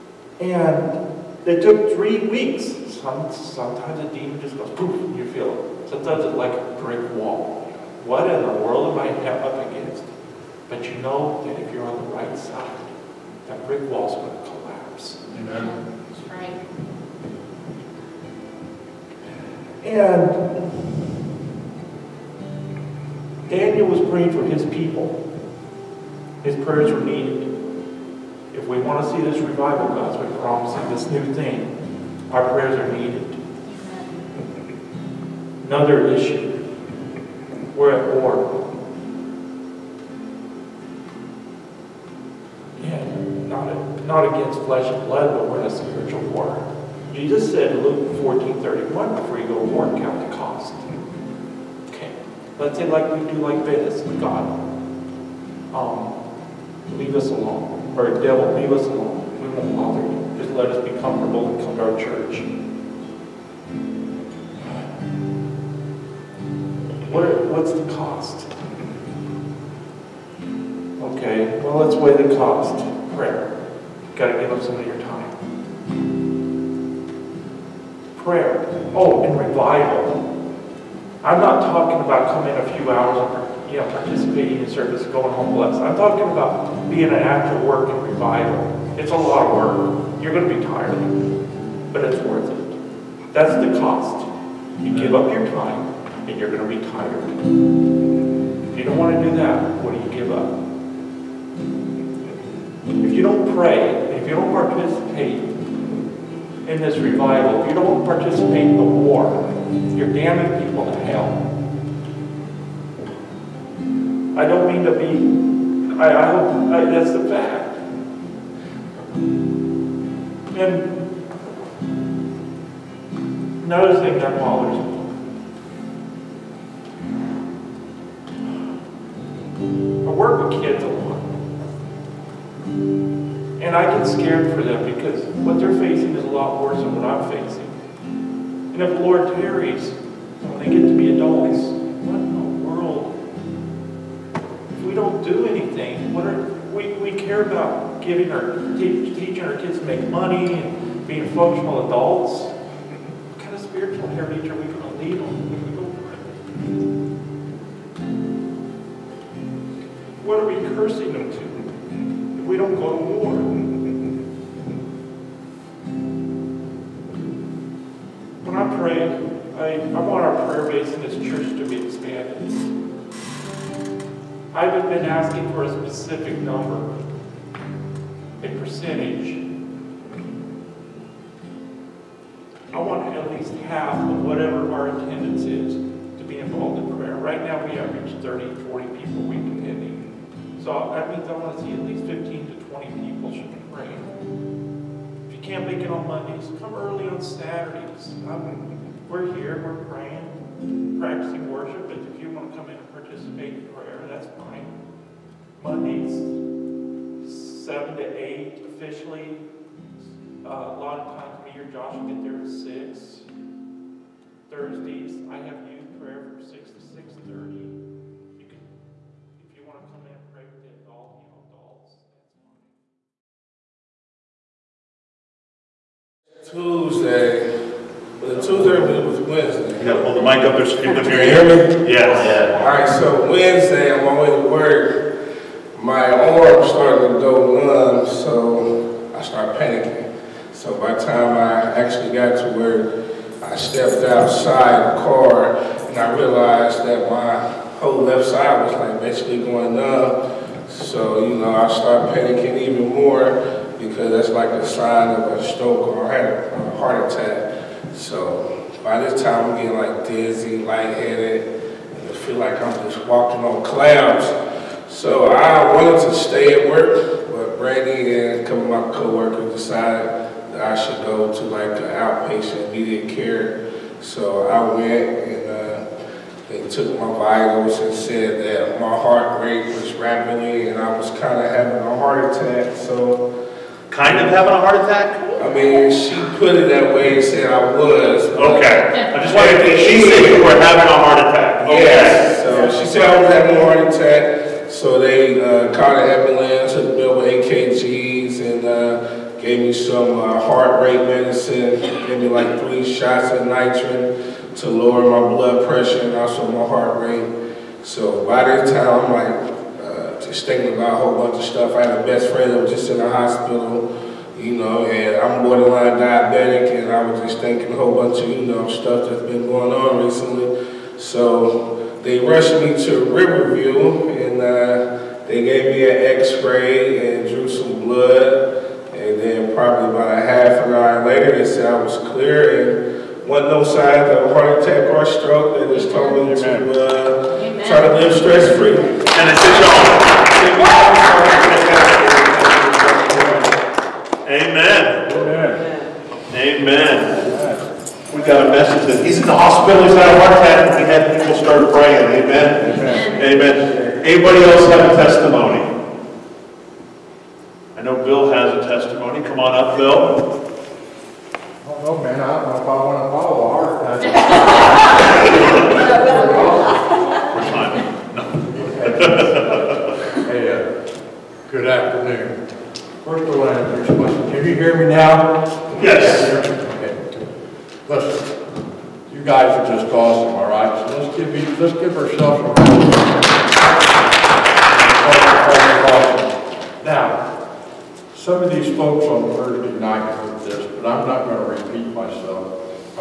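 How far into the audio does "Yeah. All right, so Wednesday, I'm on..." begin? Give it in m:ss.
3:52.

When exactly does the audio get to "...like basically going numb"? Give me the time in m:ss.
4:08.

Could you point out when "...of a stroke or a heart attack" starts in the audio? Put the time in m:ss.
4:15.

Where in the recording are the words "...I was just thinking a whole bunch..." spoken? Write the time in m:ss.
5:16.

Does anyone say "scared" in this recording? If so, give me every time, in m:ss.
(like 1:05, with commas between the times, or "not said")
2:14.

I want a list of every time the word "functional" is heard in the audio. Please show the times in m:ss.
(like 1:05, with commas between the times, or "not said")
2:31.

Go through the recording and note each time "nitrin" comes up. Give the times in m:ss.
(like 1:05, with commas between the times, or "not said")
5:03.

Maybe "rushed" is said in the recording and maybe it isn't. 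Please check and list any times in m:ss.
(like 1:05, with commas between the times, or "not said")
5:22.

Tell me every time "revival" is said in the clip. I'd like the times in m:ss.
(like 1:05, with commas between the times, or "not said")
0:29, 1:19, 1:28, 1:46.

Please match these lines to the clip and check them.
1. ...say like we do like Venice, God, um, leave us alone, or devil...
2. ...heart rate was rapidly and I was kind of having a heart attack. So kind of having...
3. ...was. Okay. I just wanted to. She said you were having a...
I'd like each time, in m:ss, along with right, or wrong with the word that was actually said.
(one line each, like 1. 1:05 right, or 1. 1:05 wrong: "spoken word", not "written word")
1. 0:52 right
2. 4:38 right
3. 4:47 right.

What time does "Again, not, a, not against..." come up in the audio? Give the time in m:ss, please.
0:42.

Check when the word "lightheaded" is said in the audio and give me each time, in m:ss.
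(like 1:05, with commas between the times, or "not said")
4:20.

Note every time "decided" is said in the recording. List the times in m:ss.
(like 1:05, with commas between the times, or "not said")
4:29.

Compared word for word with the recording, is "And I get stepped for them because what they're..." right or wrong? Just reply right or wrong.
wrong.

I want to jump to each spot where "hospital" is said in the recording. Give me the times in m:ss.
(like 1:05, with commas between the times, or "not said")
5:13, 5:49.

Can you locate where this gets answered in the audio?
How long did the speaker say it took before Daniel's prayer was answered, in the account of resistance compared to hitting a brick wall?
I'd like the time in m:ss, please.
0:01.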